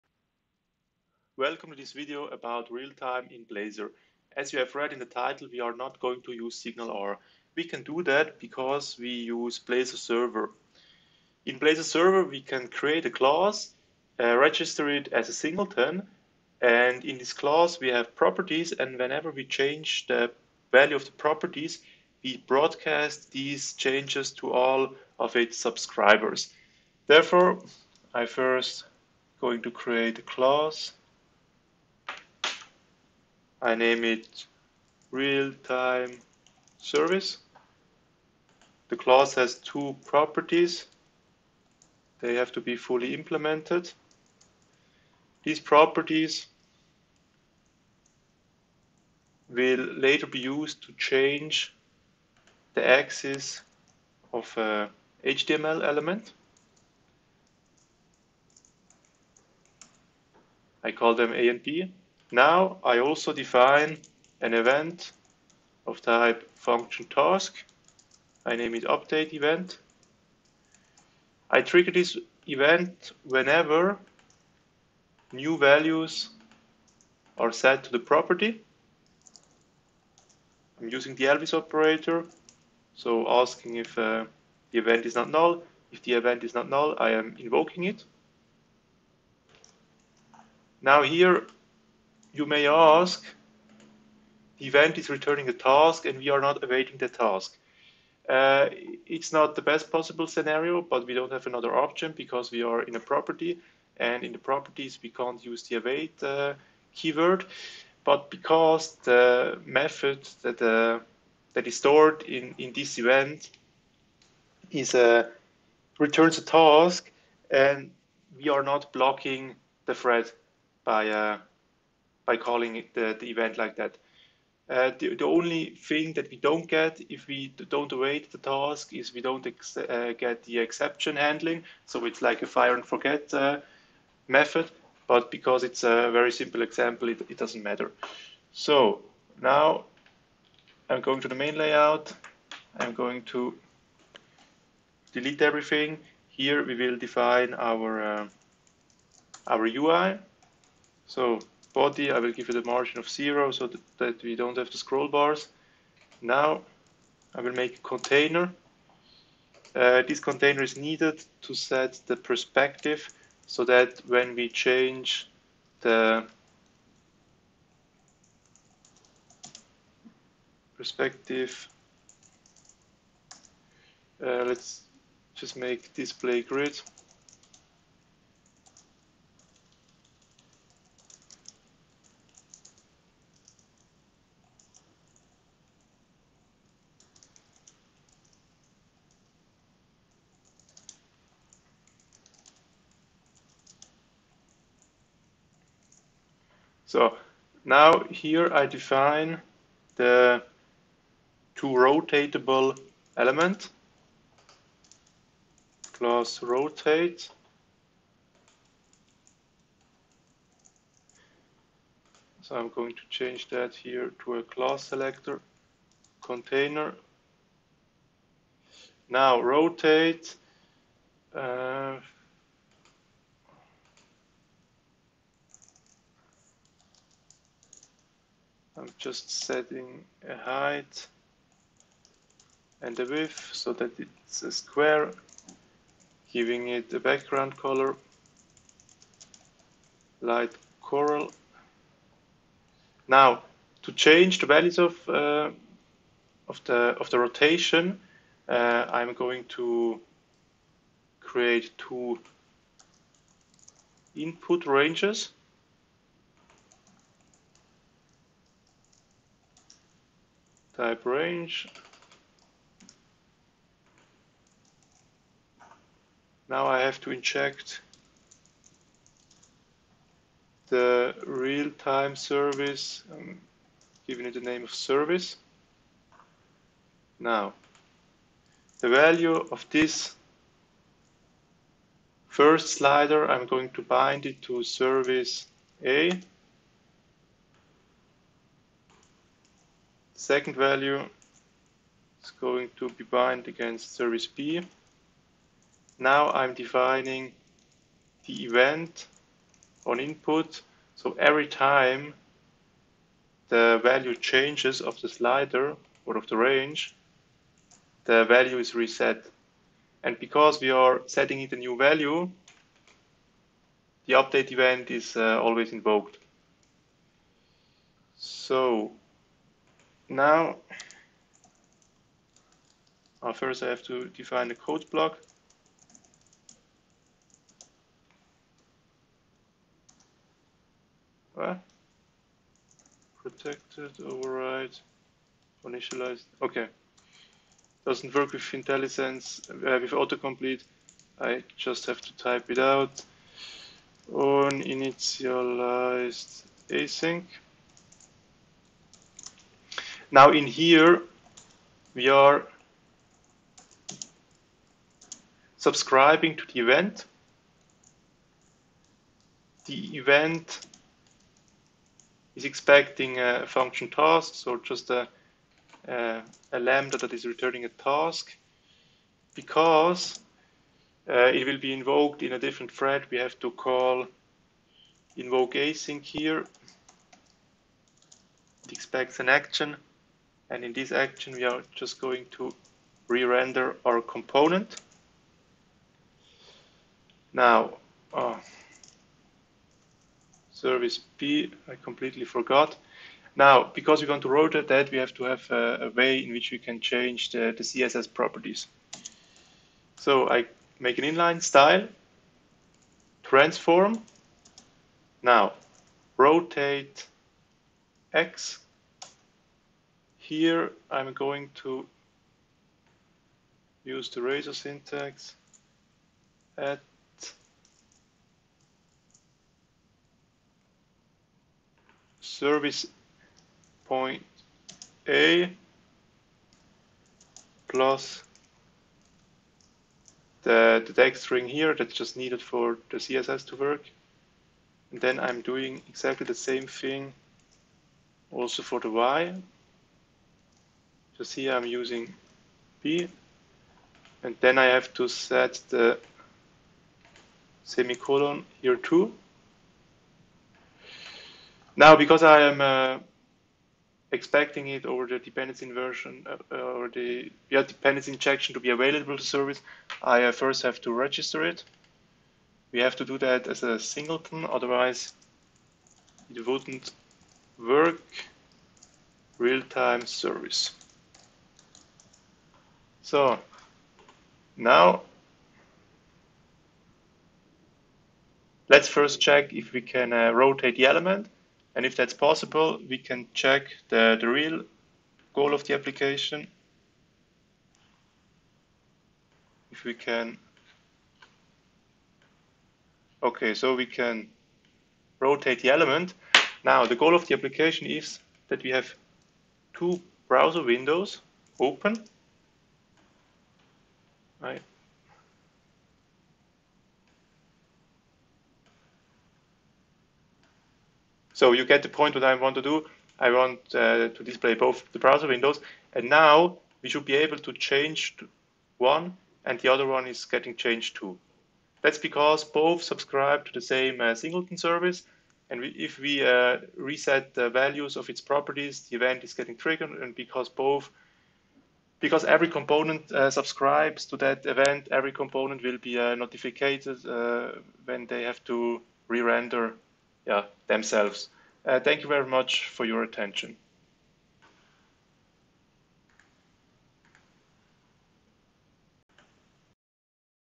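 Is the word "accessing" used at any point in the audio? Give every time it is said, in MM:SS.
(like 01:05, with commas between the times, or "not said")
not said.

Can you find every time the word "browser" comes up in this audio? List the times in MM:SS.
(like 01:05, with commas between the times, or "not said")
08:20, 08:34.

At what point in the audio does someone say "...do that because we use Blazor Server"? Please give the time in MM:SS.
00:07.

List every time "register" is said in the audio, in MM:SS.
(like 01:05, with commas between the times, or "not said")
00:14, 07:40.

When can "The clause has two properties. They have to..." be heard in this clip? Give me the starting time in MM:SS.
00:38.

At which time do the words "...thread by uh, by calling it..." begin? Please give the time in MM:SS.
01:59.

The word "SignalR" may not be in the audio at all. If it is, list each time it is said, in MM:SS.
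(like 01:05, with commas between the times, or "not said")
00:06.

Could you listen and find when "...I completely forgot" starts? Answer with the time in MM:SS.
06:31.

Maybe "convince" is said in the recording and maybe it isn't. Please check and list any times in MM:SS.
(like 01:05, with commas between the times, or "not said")
not said.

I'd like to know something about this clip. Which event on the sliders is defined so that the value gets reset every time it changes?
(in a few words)
on input.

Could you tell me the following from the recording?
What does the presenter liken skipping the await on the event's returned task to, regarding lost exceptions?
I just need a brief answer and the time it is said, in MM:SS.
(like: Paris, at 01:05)
fire and forget, at 02:12.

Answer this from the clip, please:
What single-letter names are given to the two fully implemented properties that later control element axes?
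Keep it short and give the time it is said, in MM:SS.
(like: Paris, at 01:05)
A and B, at 01:01.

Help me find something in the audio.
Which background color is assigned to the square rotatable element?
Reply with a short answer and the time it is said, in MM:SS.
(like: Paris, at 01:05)
light coral, at 04:00.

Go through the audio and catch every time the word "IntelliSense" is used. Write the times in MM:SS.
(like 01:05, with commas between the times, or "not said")
05:38.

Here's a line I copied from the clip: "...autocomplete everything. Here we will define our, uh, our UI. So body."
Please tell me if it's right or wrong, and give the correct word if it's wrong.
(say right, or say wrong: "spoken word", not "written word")
wrong: "delete", not "autocomplete".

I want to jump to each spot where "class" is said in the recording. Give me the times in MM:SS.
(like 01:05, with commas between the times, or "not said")
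00:13, 00:17, 00:30, 03:25, 03:34.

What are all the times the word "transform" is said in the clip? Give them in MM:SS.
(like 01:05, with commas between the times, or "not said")
06:43.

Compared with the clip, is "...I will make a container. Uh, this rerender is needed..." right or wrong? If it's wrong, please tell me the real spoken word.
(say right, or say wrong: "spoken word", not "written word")
wrong: "container", not "rerender".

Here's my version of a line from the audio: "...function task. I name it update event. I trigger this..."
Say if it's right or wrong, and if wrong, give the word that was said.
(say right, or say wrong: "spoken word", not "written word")
right.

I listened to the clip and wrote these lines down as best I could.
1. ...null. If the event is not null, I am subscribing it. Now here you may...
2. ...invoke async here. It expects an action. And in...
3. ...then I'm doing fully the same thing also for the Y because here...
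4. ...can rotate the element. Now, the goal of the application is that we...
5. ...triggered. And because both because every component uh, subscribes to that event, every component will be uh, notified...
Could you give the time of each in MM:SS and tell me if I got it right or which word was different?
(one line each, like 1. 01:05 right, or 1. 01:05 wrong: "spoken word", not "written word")
1. 01:25 wrong: "invoking", not "subscribing"
2. 06:15 right
3. 07:15 wrong: "exactly", not "fully"
4. 08:13 right
5. 08:49 right.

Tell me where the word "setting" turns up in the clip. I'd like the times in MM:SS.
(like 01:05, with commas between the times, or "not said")
03:49, 05:11.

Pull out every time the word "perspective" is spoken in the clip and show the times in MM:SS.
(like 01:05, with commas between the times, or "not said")
02:42, 02:50.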